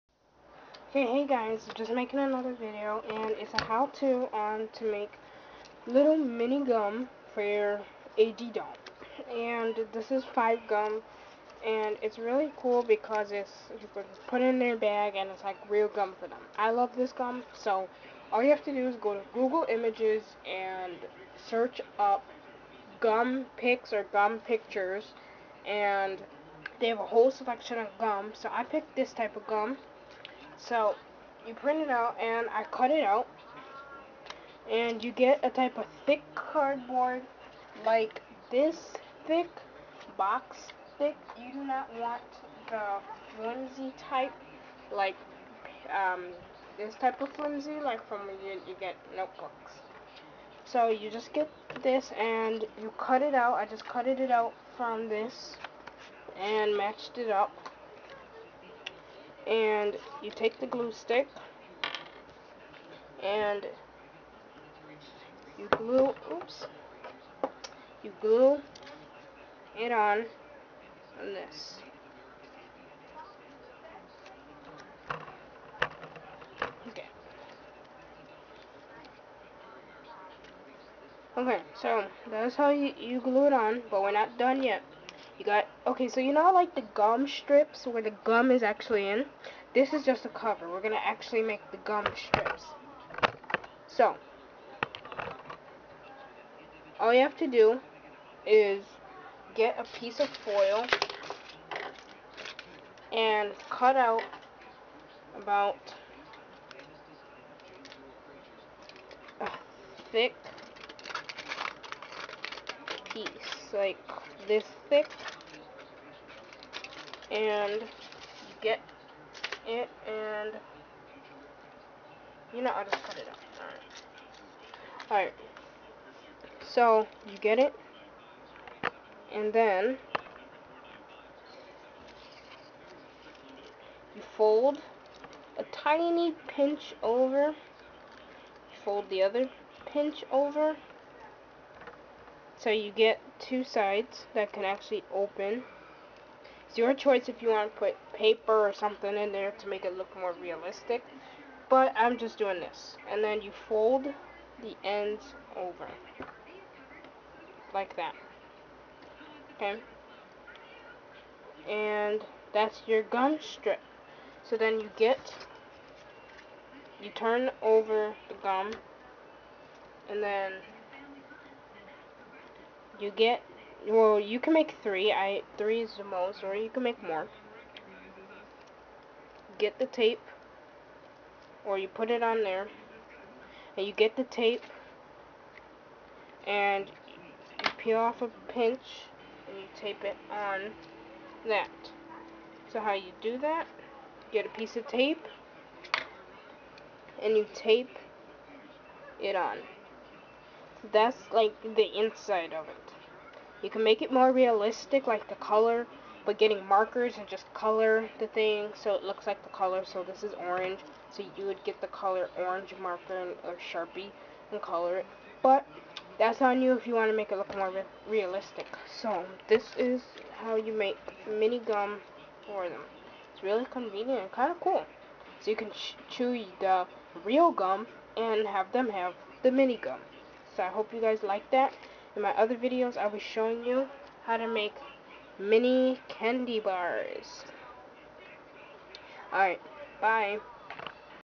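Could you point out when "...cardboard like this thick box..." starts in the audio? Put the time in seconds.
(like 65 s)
36 s.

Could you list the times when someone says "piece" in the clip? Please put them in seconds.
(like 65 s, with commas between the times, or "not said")
99 s, 113 s, 194 s.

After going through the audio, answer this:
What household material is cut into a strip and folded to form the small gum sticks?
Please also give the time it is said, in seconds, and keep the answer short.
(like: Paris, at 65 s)
Foil, at 100 s.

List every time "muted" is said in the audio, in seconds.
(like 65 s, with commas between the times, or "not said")
not said.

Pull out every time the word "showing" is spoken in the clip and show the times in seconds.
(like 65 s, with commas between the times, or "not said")
233 s.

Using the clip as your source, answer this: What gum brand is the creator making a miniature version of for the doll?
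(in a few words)
Five.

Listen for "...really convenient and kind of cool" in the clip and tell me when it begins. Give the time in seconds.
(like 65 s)
223 s.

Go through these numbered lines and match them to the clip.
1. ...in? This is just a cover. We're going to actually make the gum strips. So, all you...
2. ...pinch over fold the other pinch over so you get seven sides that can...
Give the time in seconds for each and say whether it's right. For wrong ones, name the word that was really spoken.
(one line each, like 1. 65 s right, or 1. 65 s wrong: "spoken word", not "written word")
1. 89 s right
2. 136 s wrong: "two", not "seven".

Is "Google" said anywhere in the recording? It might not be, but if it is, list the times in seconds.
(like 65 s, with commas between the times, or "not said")
19 s.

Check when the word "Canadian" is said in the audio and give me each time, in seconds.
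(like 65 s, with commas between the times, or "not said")
not said.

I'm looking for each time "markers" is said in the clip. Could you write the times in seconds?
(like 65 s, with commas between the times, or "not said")
206 s, 212 s.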